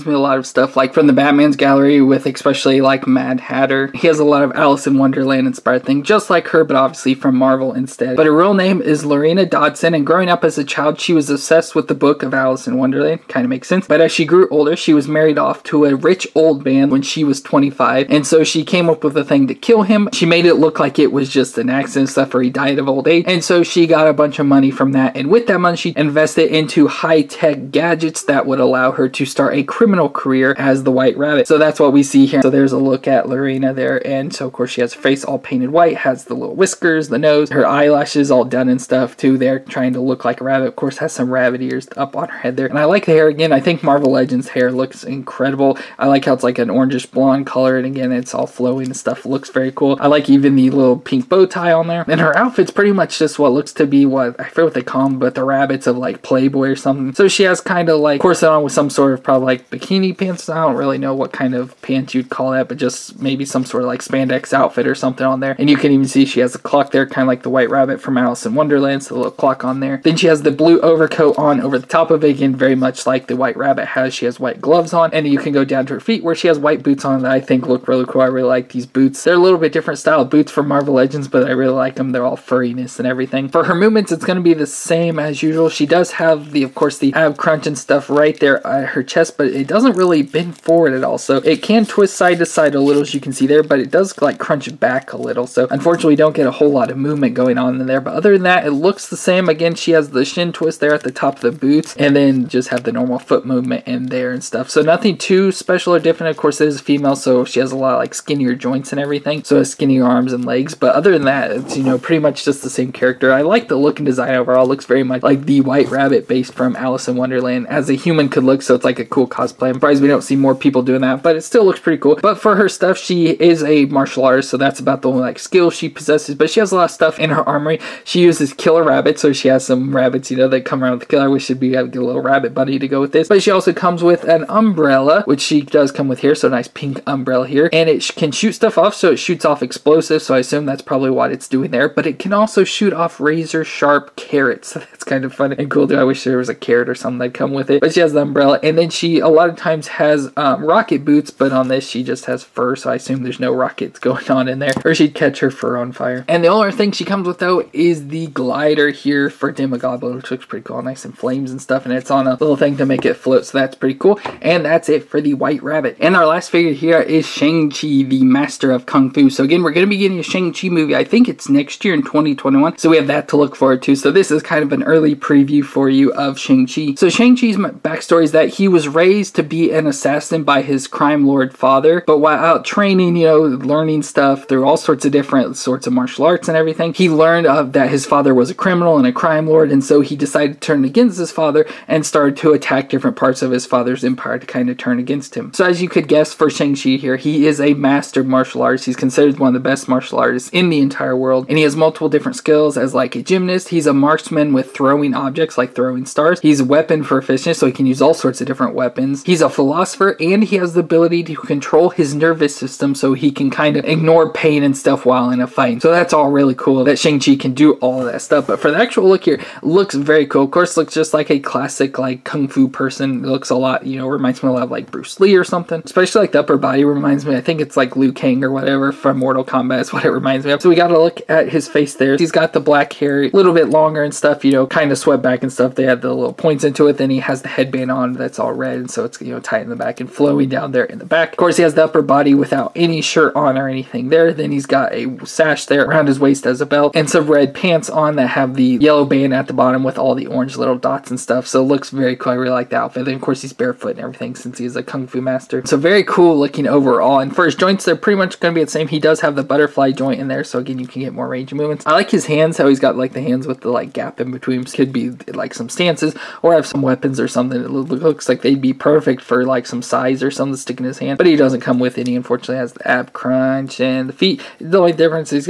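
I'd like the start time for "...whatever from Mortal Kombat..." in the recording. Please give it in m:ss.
3:48.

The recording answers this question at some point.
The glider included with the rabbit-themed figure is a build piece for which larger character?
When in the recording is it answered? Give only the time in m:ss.
2:39.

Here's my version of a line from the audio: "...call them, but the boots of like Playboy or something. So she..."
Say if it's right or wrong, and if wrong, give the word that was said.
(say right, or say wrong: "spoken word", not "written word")
wrong: "rabbits", not "boots".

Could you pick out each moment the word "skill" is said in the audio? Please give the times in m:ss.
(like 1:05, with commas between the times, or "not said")
2:05, 3:22.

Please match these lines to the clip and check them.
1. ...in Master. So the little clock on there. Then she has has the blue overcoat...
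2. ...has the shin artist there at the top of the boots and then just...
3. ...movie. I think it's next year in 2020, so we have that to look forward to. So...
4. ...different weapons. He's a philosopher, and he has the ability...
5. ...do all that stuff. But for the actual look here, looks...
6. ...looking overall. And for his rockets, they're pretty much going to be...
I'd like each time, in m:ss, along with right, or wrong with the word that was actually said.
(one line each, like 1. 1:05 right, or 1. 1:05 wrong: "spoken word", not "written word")
1. 1:08 wrong: "Wonderland", not "Master"
2. 1:39 wrong: "twist", not "artist"
3. 2:50 wrong: "2021", not "2020"
4. 3:28 right
5. 3:37 right
6. 4:16 wrong: "joints", not "rockets".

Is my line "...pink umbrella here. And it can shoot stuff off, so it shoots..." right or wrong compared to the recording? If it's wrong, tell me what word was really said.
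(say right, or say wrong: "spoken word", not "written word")
right.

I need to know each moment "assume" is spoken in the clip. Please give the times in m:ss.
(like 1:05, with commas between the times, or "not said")
2:20, 2:32.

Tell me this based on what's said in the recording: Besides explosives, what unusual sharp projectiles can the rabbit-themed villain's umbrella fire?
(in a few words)
Razor sharp carrots.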